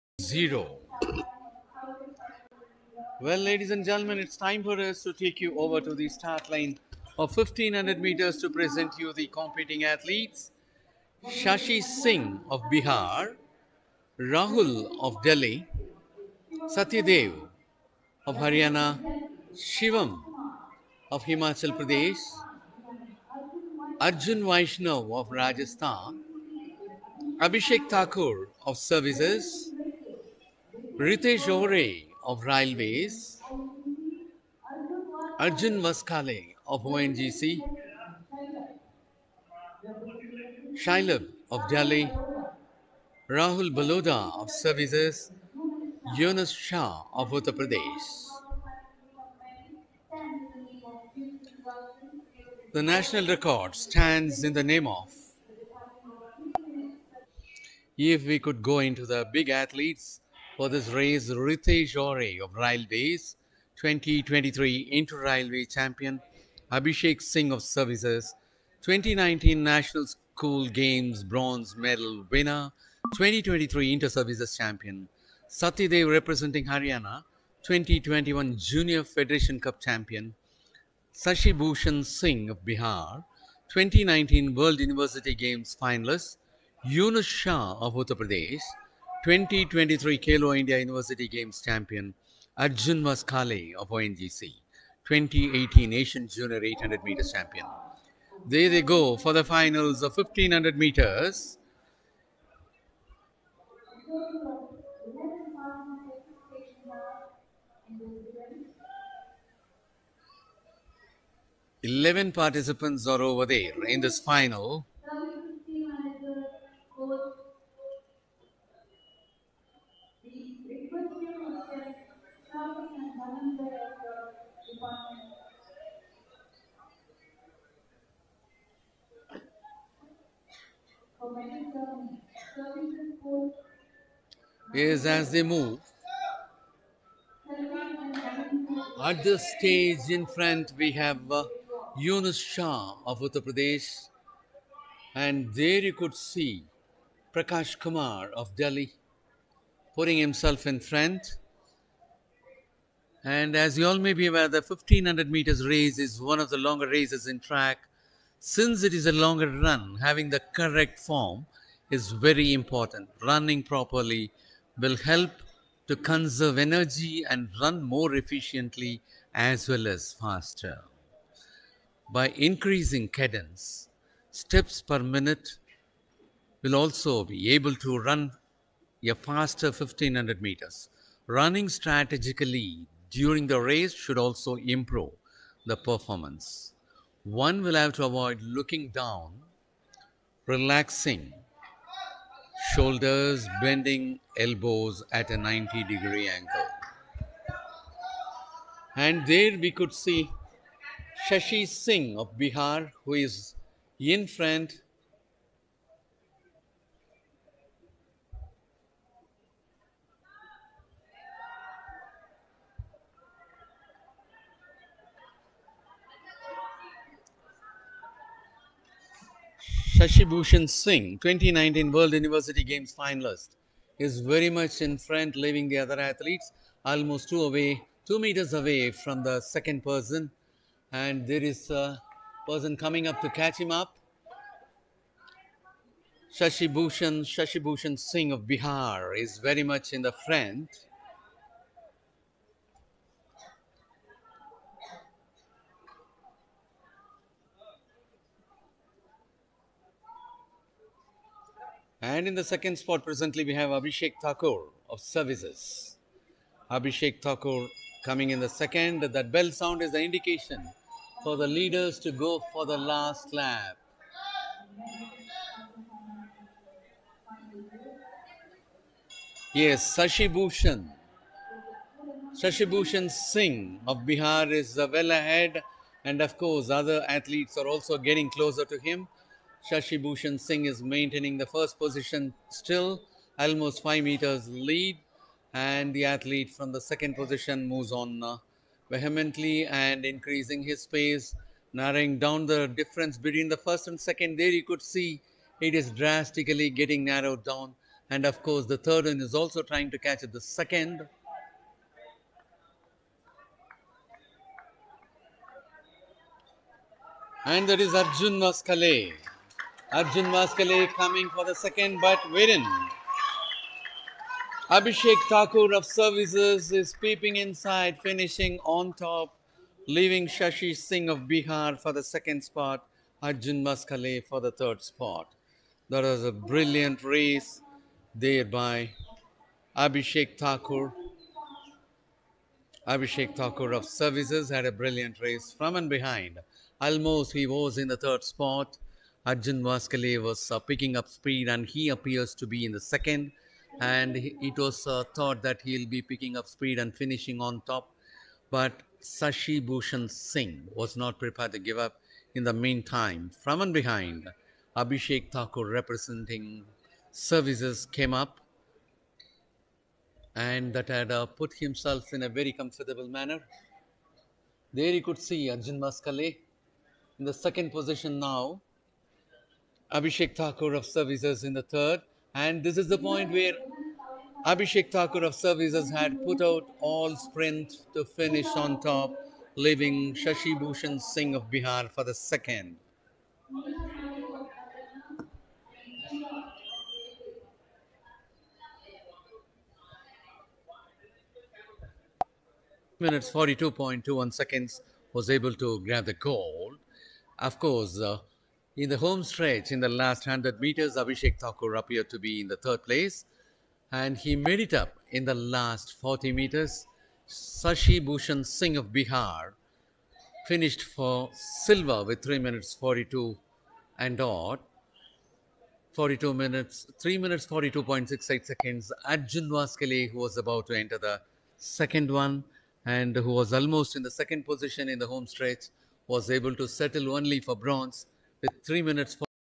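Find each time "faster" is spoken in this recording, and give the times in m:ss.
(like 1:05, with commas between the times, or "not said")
2:50, 2:59.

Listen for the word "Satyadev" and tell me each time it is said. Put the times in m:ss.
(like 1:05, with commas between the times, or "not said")
0:16, 1:15.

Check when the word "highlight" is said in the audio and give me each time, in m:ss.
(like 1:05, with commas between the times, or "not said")
not said.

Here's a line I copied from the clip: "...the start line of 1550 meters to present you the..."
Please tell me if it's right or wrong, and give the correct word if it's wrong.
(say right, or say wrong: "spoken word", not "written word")
wrong: "1500", not "1550".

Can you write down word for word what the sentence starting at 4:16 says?
Abhishek Thakur coming in the second.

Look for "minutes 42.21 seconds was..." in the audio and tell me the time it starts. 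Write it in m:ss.
6:33.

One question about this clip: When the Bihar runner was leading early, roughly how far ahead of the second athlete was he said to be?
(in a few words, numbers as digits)
2 meters.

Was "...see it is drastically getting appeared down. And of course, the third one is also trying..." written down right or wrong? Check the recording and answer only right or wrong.
wrong.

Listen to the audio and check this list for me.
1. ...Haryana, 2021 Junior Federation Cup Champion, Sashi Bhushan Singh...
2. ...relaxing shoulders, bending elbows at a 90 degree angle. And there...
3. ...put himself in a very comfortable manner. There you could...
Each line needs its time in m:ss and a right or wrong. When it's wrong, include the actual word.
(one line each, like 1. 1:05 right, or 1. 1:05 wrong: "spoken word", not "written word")
1. 1:16 right
2. 3:10 right
3. 6:01 right.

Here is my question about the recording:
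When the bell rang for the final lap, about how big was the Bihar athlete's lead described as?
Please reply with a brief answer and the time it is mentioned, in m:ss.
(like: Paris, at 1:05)
5 meters, at 4:43.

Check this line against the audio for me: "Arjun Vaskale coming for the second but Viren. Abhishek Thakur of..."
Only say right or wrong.
right.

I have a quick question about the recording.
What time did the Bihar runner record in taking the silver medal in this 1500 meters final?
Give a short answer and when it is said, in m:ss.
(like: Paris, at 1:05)
3:42.68, at 6:56.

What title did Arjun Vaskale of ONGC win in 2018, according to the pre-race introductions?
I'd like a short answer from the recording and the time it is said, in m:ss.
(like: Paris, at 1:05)
Asian Junior 800 meters champion, at 1:35.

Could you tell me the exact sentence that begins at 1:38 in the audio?
There they go for the finals of 1500 meters.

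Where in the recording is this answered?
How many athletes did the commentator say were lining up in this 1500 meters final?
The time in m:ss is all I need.
1:51.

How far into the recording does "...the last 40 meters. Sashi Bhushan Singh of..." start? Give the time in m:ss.
6:45.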